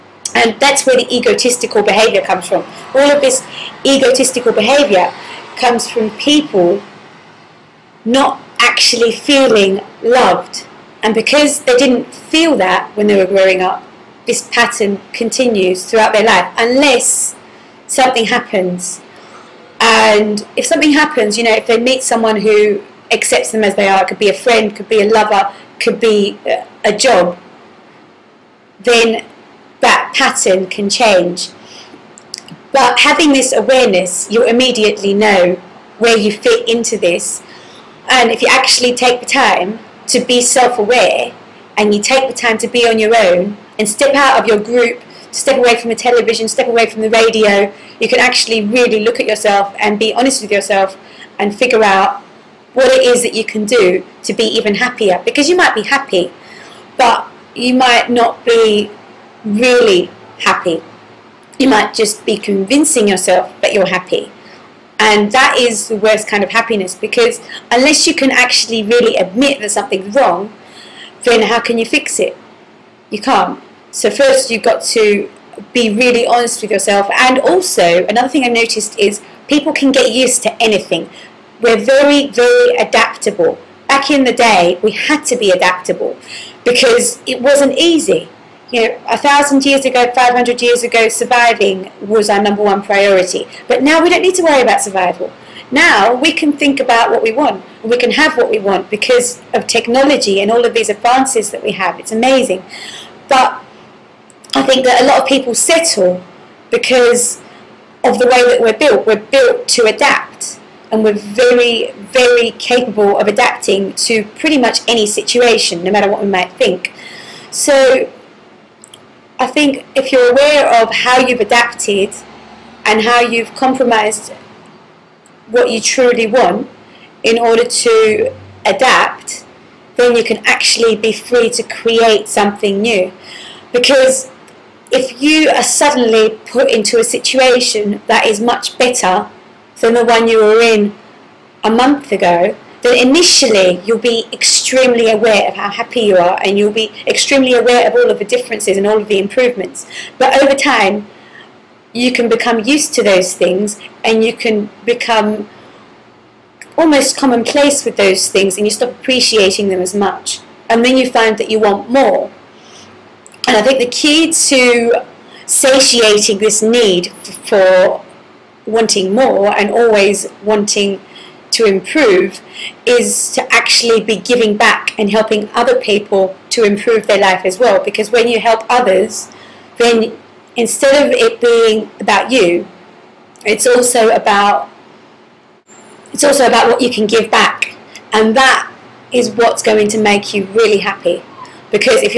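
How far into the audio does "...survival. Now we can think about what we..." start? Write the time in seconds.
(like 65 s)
94 s.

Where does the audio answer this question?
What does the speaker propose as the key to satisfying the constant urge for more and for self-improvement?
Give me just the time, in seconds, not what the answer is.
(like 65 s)
174 s.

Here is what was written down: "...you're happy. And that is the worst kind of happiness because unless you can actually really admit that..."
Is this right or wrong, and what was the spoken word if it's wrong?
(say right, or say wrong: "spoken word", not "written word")
right.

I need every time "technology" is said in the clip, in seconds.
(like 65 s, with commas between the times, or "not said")
99 s.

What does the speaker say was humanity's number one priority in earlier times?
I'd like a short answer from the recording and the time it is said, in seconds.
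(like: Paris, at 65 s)
surviving, at 91 s.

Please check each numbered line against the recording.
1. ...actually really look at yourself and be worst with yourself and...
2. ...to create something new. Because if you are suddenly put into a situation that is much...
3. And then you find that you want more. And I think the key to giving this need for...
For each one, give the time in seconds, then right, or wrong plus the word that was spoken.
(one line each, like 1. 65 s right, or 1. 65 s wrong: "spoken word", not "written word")
1. 48 s wrong: "honest", not "worst"
2. 131 s right
3. 160 s wrong: "satiating", not "giving".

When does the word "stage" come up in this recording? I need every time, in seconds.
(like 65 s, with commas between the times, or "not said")
not said.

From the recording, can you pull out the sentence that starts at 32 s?
But having this awareness, you immediately know where you fit into this.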